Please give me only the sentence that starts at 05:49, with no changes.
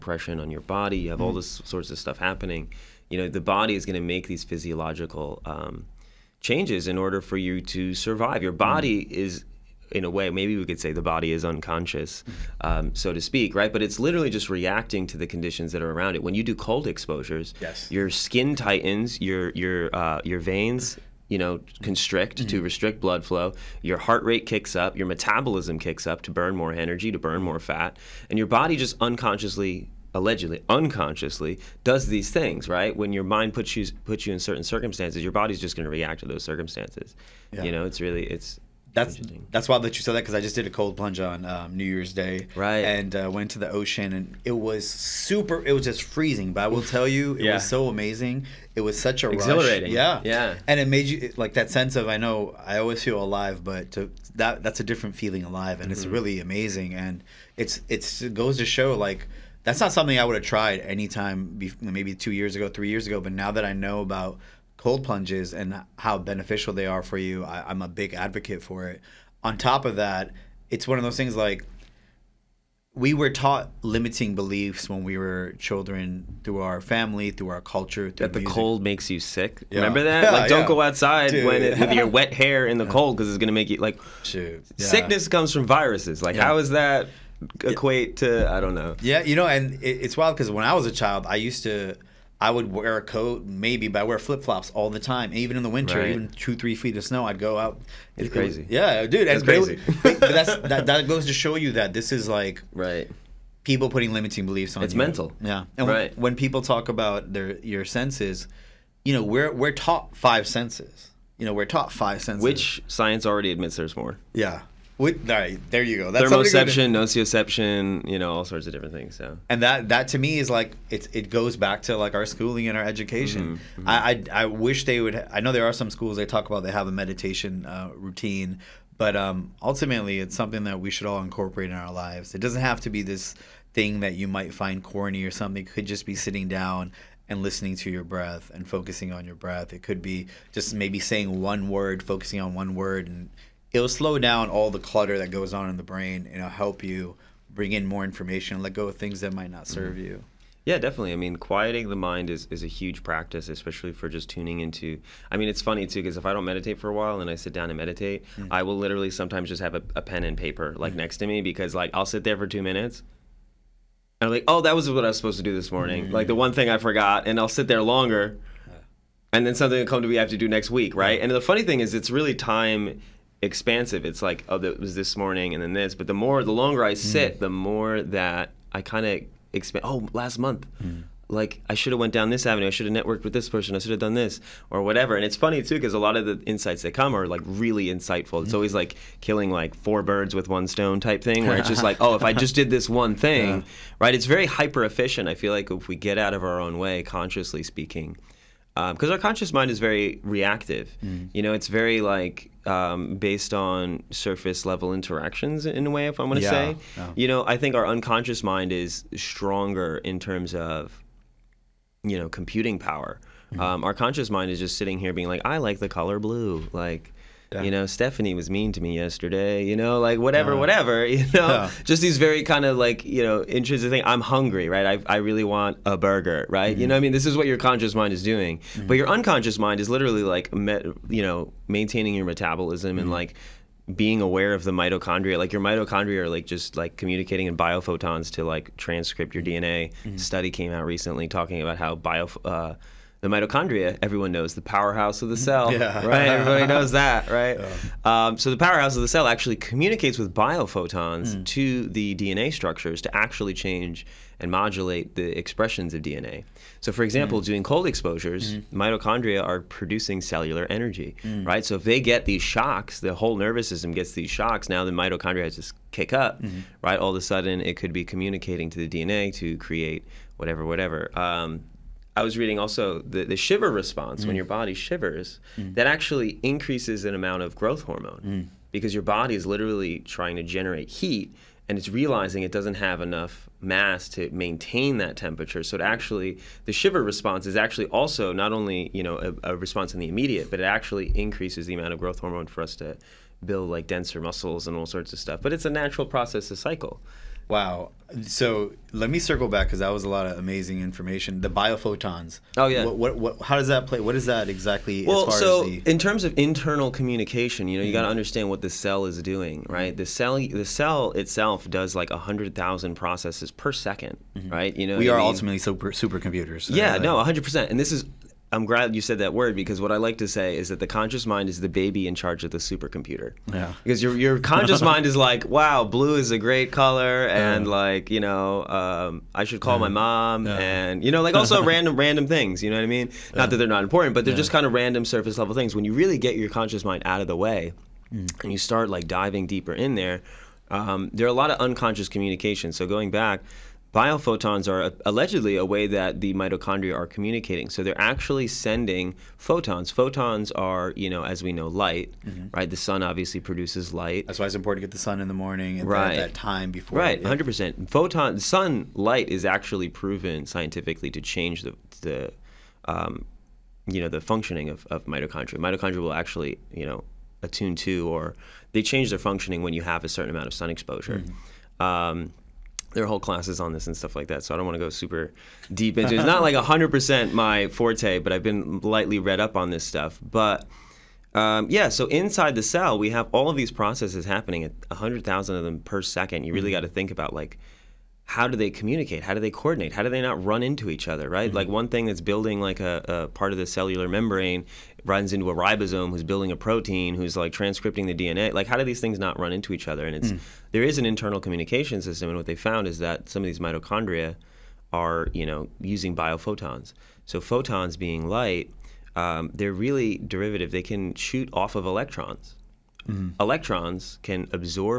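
Photons are, you know, as we know, light, mm-hmm.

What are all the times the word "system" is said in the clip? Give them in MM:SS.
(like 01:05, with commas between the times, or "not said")
04:23, 06:42.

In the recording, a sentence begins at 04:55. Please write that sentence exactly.
But it's a natural process, a cycle.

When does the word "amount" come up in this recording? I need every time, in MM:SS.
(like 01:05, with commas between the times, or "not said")
04:37, 04:51, 06:10.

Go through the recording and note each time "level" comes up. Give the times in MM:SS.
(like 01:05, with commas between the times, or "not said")
03:24, 05:35.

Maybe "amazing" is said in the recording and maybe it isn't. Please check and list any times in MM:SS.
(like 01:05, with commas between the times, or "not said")
00:47, 00:56, 05:00.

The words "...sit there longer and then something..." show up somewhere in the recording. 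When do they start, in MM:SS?
02:47.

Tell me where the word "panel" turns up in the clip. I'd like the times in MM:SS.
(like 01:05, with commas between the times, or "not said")
not said.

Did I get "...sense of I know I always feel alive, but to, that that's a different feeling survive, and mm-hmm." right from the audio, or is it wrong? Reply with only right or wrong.
wrong.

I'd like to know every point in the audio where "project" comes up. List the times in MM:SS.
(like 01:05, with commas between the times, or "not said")
not said.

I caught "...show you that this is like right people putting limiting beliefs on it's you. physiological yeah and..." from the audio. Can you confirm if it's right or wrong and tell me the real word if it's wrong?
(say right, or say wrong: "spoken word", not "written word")
wrong: "mental", not "physiological".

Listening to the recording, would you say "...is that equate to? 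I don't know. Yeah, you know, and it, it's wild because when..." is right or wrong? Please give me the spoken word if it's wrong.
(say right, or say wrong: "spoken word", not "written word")
right.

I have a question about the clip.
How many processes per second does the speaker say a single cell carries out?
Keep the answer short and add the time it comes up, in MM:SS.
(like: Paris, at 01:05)
100,000, at 06:24.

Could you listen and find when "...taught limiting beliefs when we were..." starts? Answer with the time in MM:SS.
01:13.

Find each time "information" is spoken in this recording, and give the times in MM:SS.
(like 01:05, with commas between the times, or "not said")
02:28, 05:00.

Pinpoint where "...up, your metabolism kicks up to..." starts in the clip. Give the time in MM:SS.
00:24.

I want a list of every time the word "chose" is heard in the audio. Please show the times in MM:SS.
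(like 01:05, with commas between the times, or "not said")
not said.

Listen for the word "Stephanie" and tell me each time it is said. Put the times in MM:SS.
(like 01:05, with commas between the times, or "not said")
03:37.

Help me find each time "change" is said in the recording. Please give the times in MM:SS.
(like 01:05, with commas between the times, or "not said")
00:06, 04:13, 06:01, 06:08.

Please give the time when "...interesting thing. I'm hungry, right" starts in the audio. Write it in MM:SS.
03:43.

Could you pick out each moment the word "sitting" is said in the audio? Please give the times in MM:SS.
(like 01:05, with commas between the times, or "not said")
02:16, 03:34.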